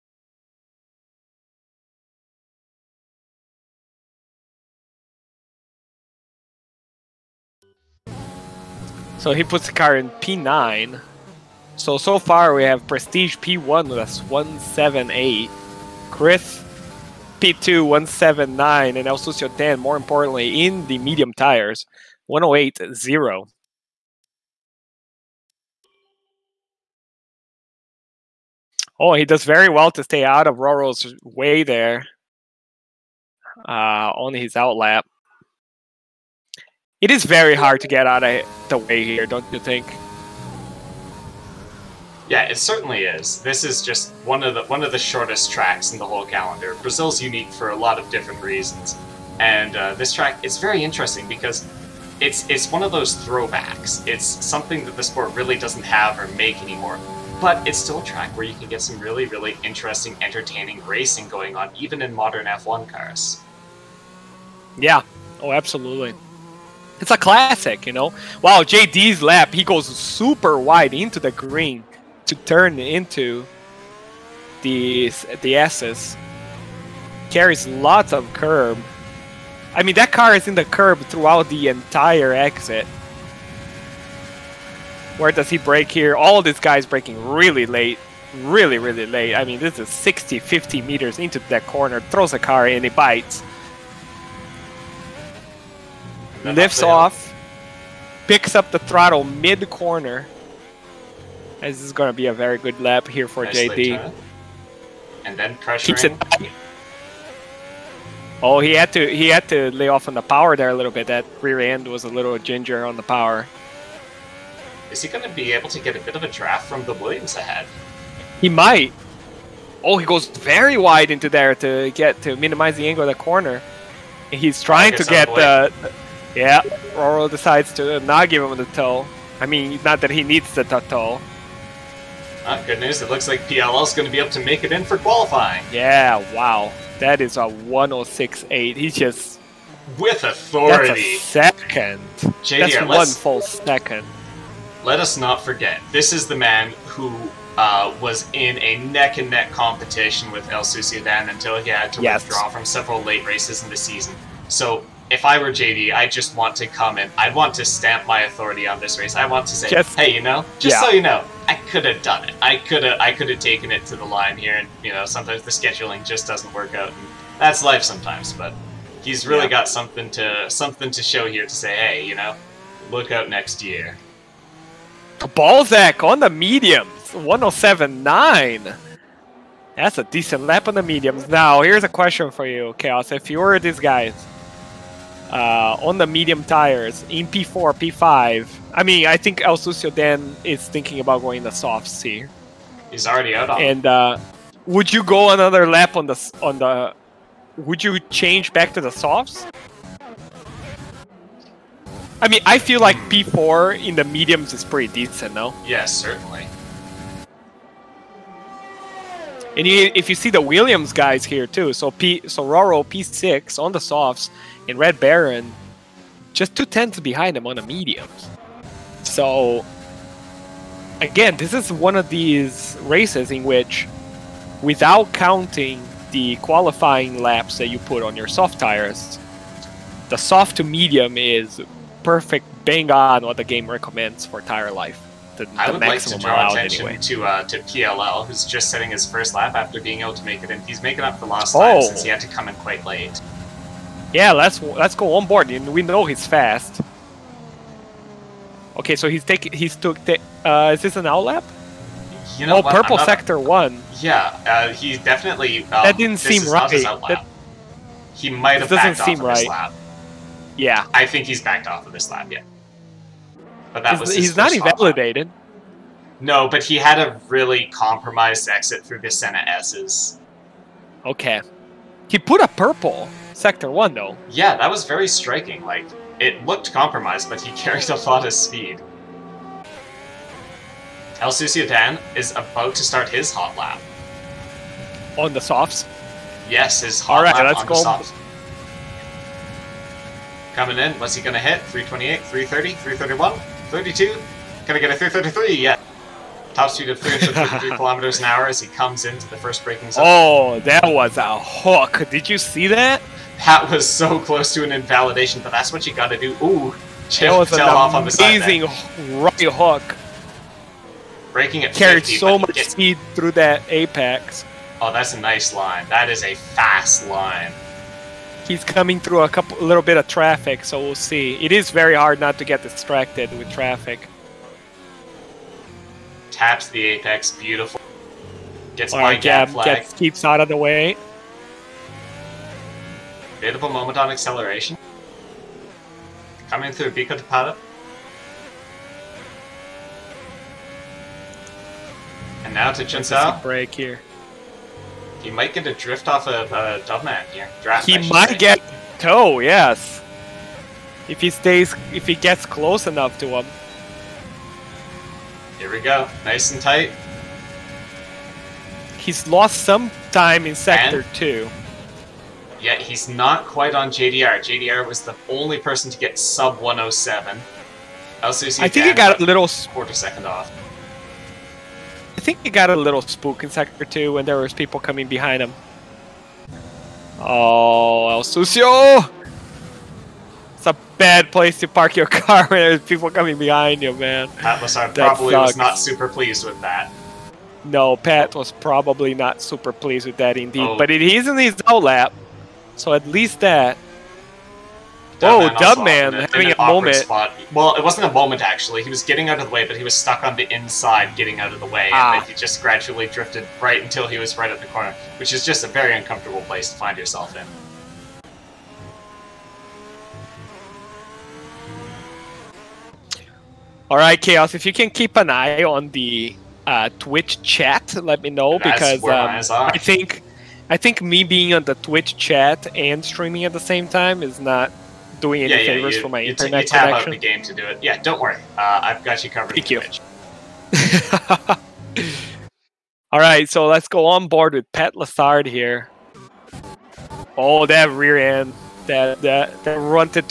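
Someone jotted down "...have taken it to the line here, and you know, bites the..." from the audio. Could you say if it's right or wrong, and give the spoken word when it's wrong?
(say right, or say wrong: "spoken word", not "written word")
wrong: "sometimes", not "bites".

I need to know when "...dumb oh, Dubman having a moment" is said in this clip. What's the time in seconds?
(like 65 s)
395 s.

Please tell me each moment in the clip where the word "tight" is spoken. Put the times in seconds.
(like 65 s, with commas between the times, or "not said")
356 s.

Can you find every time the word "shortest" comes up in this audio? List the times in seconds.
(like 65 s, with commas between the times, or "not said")
45 s.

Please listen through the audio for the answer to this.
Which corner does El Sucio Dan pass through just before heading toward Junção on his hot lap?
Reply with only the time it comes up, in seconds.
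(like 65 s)
336 s.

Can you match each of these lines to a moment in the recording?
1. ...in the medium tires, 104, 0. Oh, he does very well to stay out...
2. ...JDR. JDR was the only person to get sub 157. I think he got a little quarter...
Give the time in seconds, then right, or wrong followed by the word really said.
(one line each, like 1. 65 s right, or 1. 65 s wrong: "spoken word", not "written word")
1. 20 s wrong: "108", not "104"
2. 363 s wrong: "107", not "157".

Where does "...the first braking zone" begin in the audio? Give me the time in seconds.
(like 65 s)
299 s.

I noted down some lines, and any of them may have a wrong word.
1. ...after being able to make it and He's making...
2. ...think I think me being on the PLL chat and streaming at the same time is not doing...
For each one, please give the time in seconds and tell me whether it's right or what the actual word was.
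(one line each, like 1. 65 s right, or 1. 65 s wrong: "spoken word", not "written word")
1. 239 s right
2. 419 s wrong: "Twitch", not "PLL".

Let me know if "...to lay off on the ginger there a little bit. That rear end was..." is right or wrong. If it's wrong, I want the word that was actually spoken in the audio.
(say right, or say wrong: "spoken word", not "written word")
wrong: "power", not "ginger".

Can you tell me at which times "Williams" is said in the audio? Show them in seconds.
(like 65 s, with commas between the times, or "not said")
116 s, 210 s.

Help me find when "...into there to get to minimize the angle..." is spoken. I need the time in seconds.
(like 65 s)
121 s.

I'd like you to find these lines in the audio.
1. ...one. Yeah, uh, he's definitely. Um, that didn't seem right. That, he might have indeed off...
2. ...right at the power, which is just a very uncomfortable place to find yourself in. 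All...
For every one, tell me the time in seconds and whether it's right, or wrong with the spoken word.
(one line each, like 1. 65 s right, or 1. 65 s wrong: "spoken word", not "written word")
1. 253 s wrong: "backed", not "indeed"
2. 404 s wrong: "corner", not "power".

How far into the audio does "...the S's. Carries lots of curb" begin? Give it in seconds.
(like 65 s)
75 s.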